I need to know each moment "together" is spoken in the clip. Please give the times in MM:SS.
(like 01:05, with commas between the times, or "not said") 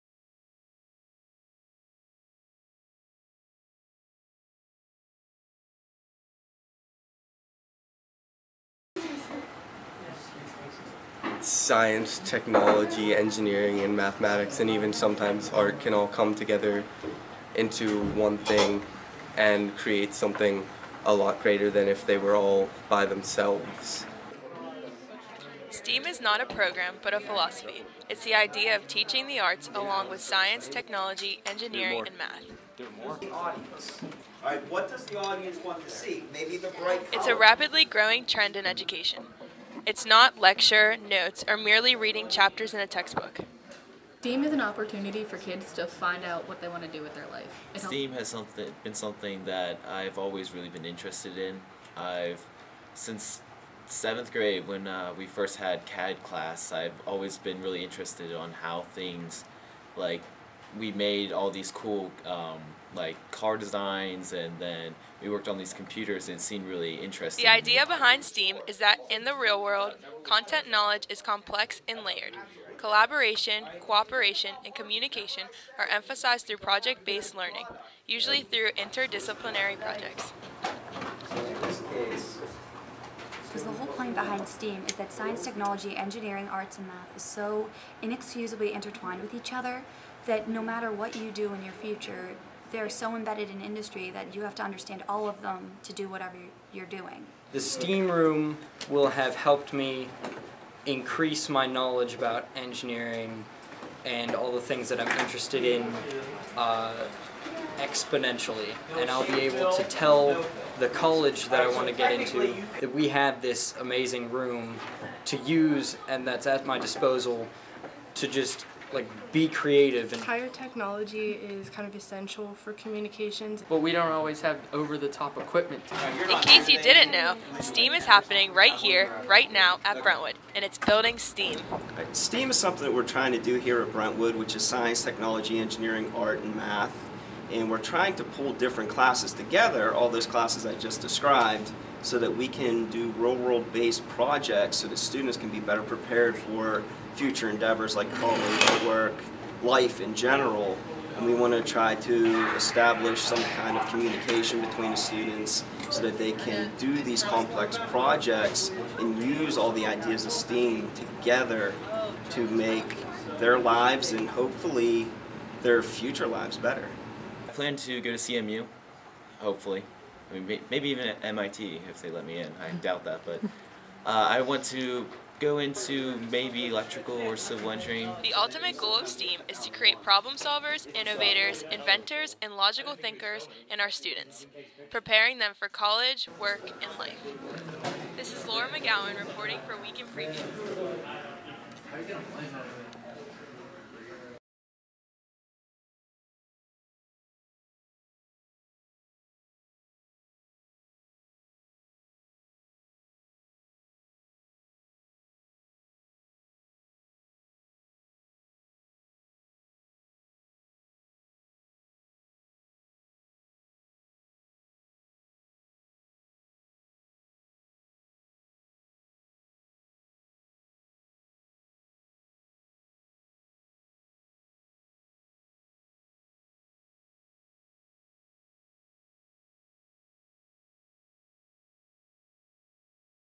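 00:16, 02:19, 02:40.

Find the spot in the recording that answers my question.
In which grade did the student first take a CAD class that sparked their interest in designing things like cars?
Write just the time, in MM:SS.
00:53.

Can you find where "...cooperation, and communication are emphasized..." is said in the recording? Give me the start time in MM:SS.
01:13.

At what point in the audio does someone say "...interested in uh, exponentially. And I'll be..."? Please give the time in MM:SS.
01:45.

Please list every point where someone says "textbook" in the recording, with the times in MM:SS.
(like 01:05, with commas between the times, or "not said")
00:42.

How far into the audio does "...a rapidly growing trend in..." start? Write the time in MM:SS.
00:37.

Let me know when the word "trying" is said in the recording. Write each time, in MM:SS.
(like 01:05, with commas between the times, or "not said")
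02:13, 02:17.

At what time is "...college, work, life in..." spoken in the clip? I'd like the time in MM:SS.
02:28.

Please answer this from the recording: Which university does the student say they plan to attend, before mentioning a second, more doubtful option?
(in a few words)
CMU.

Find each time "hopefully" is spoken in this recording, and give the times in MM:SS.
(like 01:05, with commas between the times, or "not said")
02:44, 02:49.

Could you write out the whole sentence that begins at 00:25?
STEAM is not a program, but a philosophy.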